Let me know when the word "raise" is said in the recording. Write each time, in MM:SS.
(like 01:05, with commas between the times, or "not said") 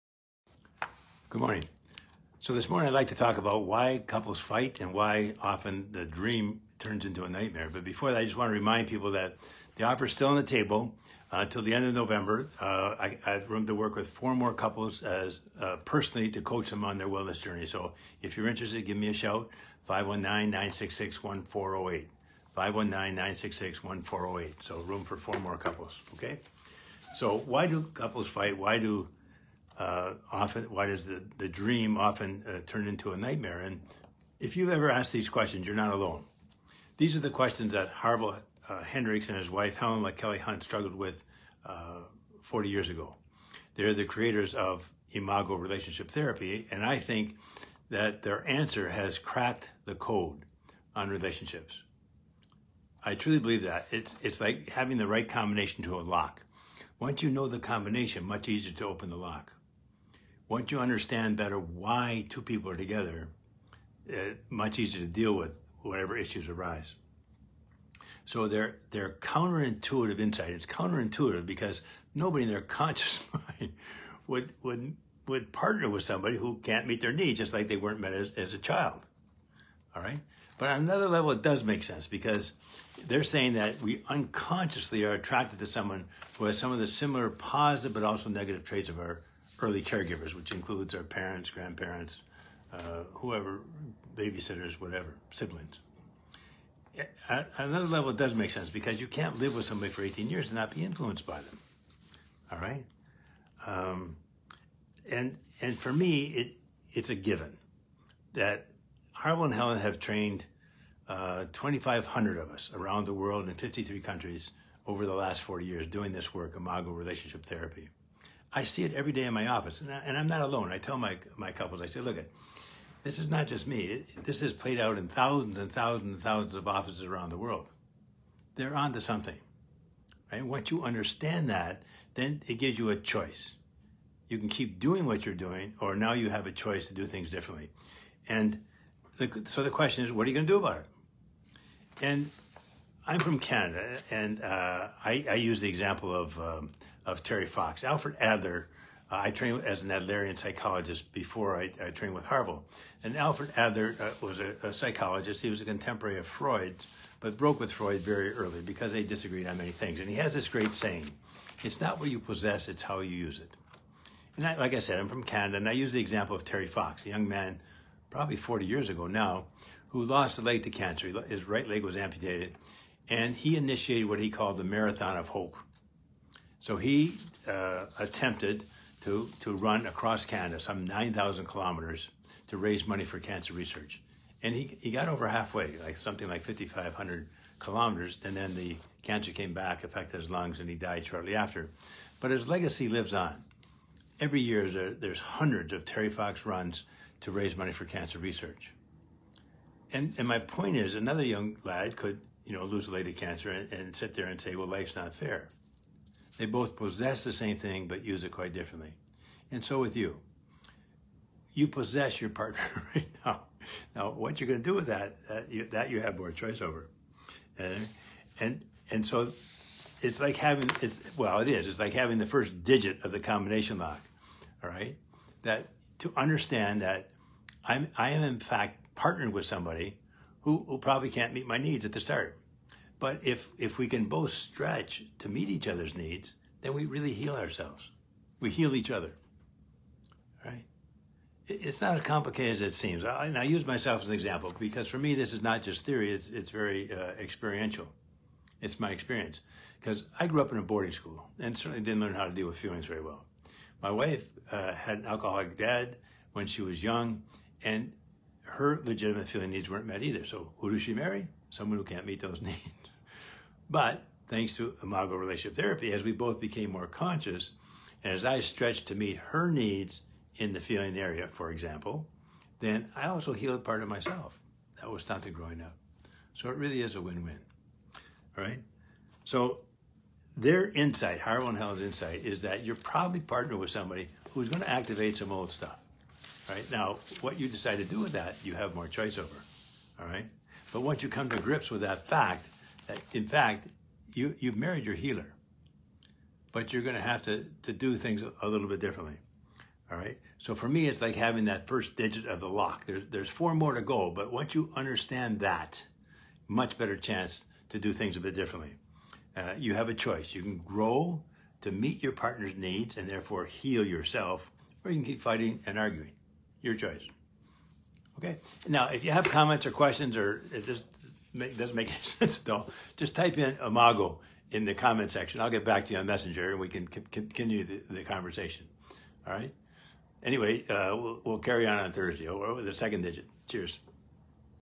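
03:02, 03:17.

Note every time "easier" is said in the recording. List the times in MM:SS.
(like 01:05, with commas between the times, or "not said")
00:58, 01:04.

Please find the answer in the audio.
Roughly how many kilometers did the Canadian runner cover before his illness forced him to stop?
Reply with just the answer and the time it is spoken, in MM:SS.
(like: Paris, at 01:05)
5,500, at 03:06.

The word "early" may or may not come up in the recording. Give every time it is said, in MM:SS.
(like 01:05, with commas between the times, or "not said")
01:29, 02:38.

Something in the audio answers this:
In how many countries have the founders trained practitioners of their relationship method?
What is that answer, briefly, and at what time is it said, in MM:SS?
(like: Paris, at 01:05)
53, at 01:53.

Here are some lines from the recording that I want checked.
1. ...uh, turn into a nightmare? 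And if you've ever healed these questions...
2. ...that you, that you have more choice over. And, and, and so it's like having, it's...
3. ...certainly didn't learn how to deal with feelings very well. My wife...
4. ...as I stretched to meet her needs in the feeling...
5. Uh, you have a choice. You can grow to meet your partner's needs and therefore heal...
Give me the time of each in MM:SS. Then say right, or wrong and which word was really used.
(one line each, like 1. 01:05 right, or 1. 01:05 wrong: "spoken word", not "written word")
1. 00:32 wrong: "asked", not "healed"
2. 03:35 right
3. 04:11 right
4. 04:28 right
5. 05:09 right.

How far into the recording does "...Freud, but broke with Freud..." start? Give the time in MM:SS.
02:36.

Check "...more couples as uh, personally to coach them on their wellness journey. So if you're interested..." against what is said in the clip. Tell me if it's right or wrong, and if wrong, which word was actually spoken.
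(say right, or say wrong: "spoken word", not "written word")
right.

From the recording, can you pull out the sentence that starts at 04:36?
So it really is a win-win, all right?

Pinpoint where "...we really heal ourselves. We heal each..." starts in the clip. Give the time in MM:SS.
03:56.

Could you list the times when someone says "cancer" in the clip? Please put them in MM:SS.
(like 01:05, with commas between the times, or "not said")
02:50, 03:03, 03:09, 03:17, 03:23.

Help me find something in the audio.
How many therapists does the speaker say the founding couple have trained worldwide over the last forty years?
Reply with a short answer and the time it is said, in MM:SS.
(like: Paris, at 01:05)
2,500, at 01:51.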